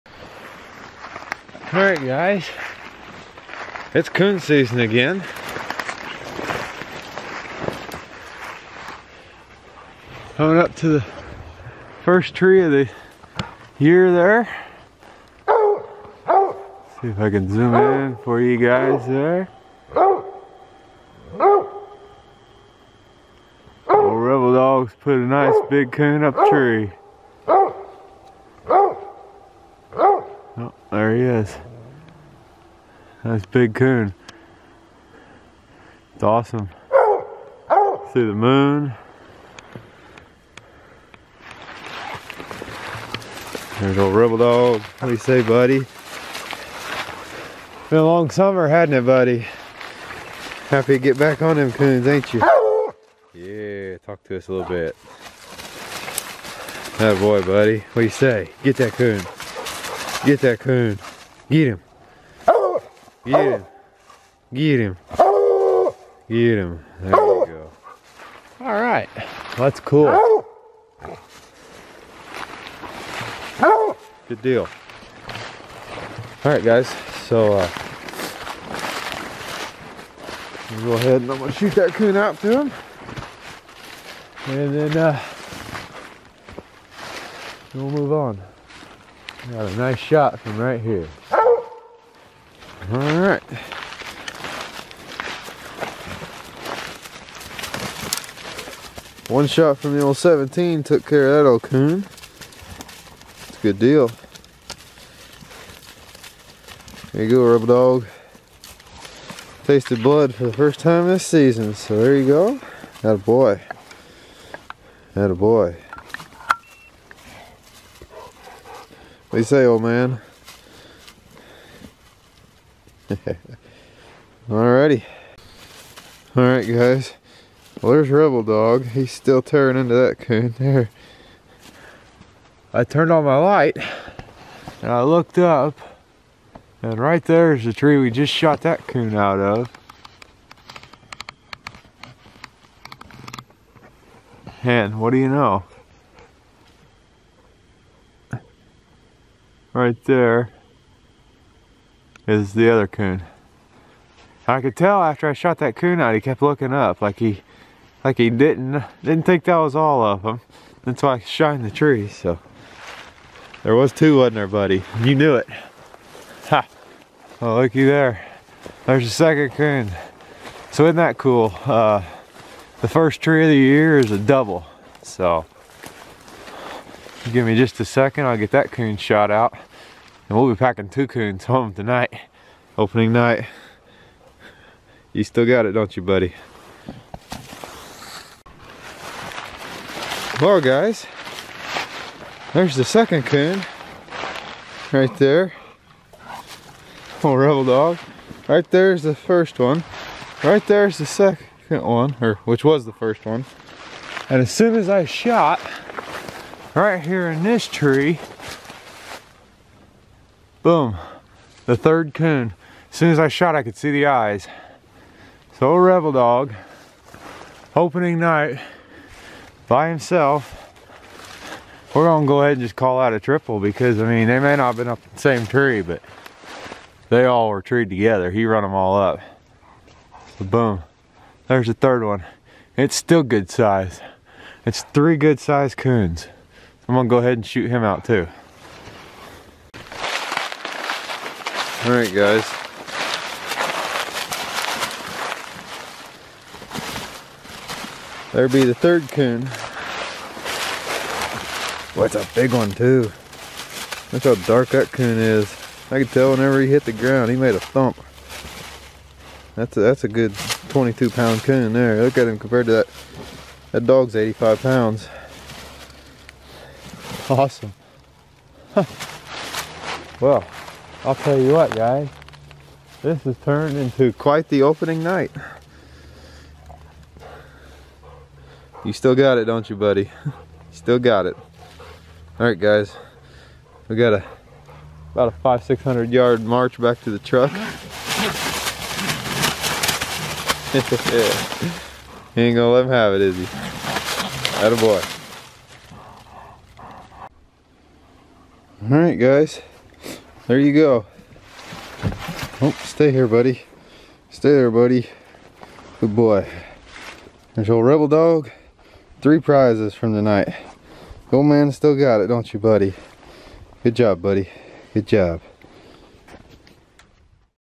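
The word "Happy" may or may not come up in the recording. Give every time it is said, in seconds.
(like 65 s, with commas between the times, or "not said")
50 s.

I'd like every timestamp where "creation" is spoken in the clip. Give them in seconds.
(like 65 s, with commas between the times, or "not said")
not said.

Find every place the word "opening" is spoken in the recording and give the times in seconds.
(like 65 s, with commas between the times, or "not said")
182 s, 217 s, 274 s.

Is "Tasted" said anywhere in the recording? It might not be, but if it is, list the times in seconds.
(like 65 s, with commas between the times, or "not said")
109 s.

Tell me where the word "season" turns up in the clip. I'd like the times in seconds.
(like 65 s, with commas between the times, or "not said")
4 s, 111 s.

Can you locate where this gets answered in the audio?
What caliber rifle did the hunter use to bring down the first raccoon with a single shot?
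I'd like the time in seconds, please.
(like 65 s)
100 s.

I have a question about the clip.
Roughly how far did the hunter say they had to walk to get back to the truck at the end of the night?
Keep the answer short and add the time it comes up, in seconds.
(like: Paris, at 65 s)
500-600 yards, at 285 s.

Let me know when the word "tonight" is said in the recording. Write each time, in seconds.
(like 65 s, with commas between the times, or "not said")
181 s, 310 s.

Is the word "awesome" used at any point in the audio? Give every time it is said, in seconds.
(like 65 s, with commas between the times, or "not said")
36 s, 267 s.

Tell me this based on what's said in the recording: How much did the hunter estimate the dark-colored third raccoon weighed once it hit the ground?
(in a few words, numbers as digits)
22 pounds.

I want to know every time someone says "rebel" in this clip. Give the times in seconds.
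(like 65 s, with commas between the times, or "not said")
23 s, 44 s, 107 s, 128 s, 197 s, 215 s, 307 s.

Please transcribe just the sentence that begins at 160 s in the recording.
That's why I shined the tree, so.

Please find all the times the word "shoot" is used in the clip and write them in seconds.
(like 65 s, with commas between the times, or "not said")
81 s, 237 s.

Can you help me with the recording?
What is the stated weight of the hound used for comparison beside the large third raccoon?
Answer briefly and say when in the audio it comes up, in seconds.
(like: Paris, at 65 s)
85 pounds, at 264 s.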